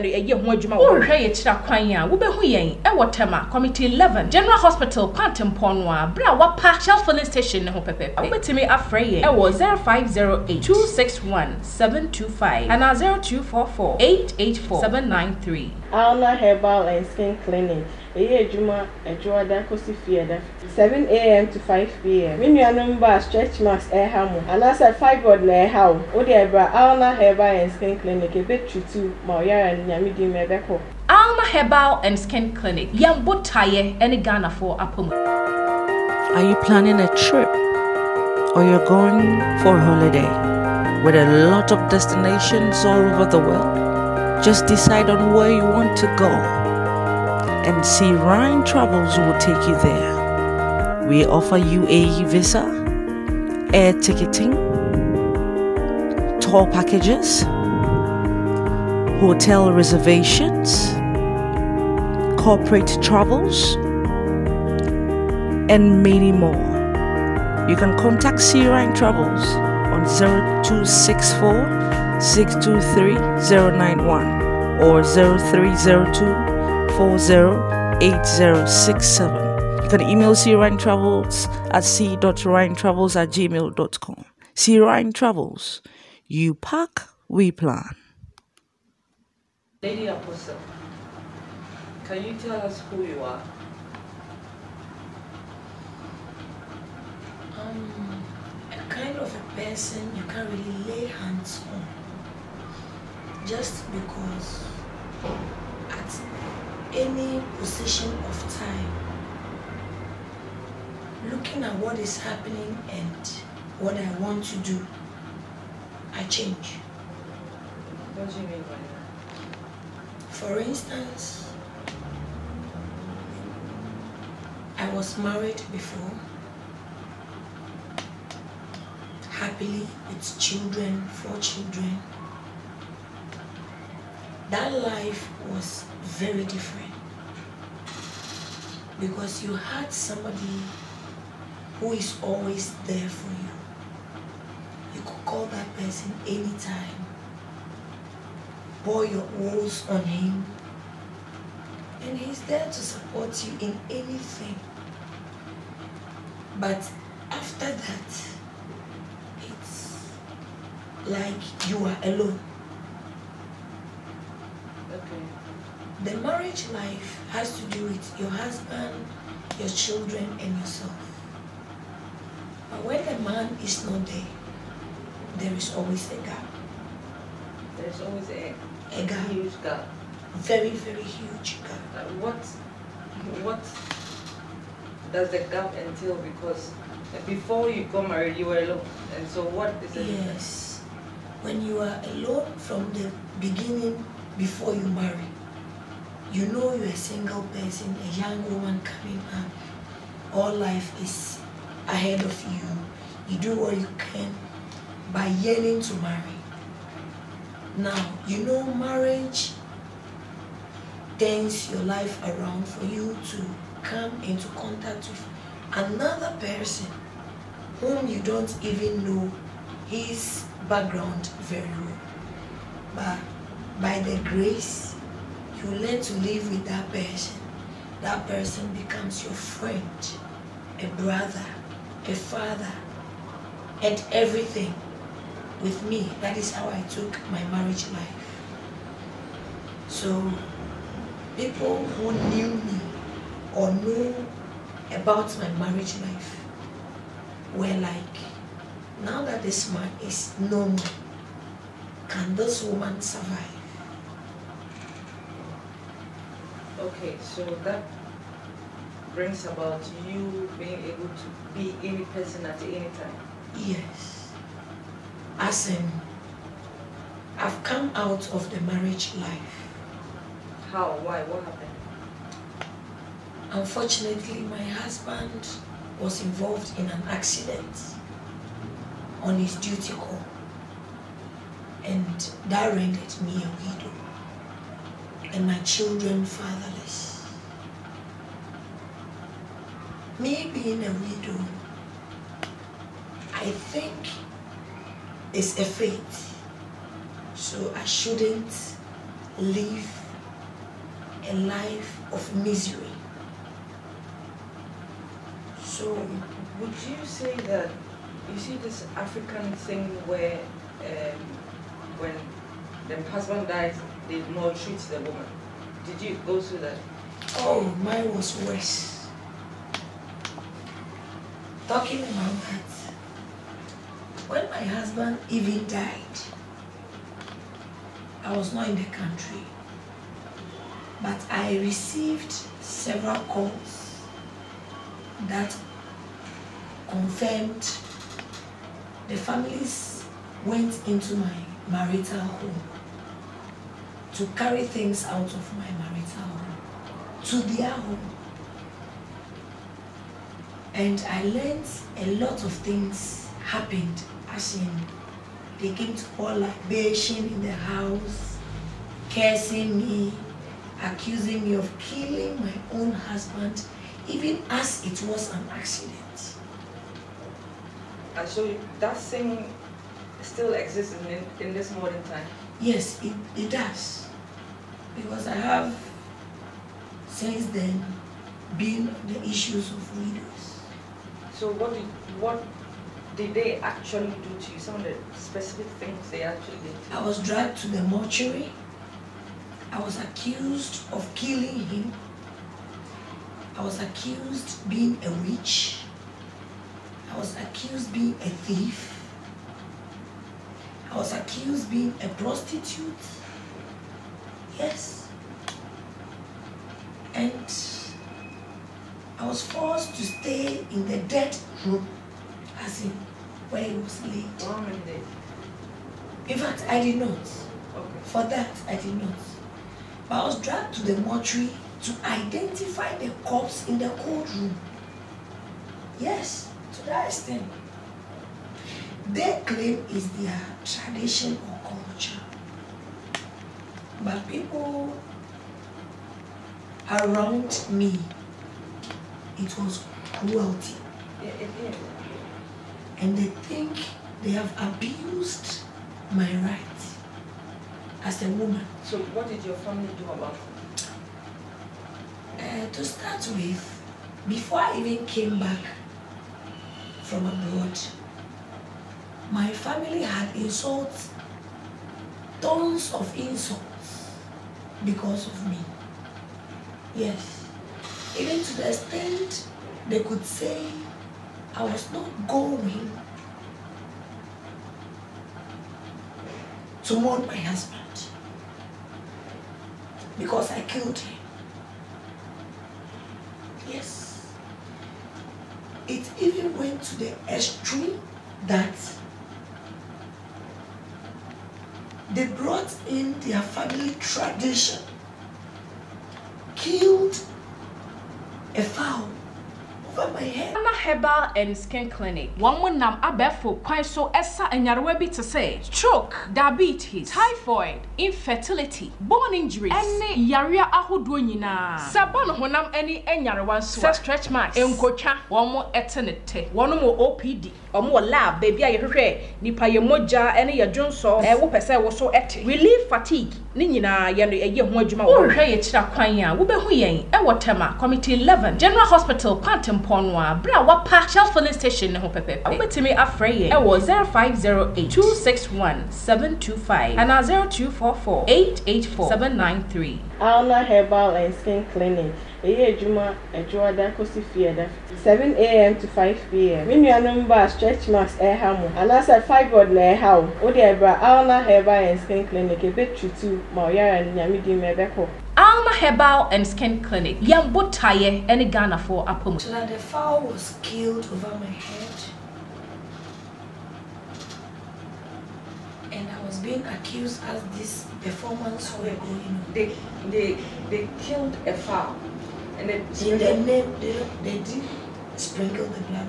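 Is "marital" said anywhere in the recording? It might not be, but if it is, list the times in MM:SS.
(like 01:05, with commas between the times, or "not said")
05:41, 05:45.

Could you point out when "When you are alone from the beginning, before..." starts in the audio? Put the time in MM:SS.
03:11.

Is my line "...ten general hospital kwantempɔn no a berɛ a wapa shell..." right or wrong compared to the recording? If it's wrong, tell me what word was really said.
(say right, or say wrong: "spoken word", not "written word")
wrong: "eleven", not "ten".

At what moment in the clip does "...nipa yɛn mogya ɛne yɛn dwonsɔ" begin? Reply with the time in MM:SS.
08:39.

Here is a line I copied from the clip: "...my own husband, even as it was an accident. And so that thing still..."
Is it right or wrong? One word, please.
right.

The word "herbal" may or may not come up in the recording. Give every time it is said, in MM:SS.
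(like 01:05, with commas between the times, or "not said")
00:16, 00:27, 00:31, 08:20, 09:00, 09:11, 09:15.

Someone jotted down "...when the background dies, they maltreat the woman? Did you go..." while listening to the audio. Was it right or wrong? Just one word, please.
wrong.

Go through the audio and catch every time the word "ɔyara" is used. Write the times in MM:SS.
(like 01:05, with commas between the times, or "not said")
00:29, 09:13.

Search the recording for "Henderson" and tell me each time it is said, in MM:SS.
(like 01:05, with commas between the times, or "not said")
not said.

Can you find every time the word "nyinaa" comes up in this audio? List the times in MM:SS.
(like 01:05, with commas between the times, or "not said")
08:31, 08:43.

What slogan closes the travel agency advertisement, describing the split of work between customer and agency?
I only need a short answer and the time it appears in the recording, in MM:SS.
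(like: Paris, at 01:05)
You pack, we plan, at 01:26.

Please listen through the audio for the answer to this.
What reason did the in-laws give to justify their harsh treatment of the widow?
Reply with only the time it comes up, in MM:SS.
07:10.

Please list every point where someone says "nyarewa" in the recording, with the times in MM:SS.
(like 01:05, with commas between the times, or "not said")
08:24, 08:33.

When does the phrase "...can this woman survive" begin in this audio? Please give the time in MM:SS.
04:12.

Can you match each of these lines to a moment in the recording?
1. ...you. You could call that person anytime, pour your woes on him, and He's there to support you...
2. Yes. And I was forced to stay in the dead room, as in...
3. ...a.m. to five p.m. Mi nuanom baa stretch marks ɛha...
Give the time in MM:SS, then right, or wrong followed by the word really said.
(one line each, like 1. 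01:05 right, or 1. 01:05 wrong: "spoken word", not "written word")
1. 02:23 right
2. 06:44 right
3. 09:05 right.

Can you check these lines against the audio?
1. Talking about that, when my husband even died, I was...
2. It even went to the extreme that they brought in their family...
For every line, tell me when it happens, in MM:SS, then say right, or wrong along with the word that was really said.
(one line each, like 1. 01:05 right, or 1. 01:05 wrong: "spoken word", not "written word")
1. 05:21 right
2. 08:05 right.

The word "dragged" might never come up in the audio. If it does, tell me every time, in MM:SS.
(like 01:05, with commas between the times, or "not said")
06:27, 07:00.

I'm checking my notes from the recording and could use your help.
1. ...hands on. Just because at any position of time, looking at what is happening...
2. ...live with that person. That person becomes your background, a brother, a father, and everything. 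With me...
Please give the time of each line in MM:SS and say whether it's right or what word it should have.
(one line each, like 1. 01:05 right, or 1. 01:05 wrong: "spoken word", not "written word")
1. 01:41 right
2. 03:46 wrong: "friend", not "background".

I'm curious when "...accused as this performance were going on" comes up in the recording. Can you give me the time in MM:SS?
09:26.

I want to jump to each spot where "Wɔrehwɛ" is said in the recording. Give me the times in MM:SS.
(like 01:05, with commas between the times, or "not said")
00:00, 08:45.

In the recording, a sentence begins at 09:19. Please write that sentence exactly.
So that the fowl was killed over my head.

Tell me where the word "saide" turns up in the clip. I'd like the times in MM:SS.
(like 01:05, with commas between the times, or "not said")
not said.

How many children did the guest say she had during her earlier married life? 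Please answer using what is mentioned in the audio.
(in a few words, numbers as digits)
4.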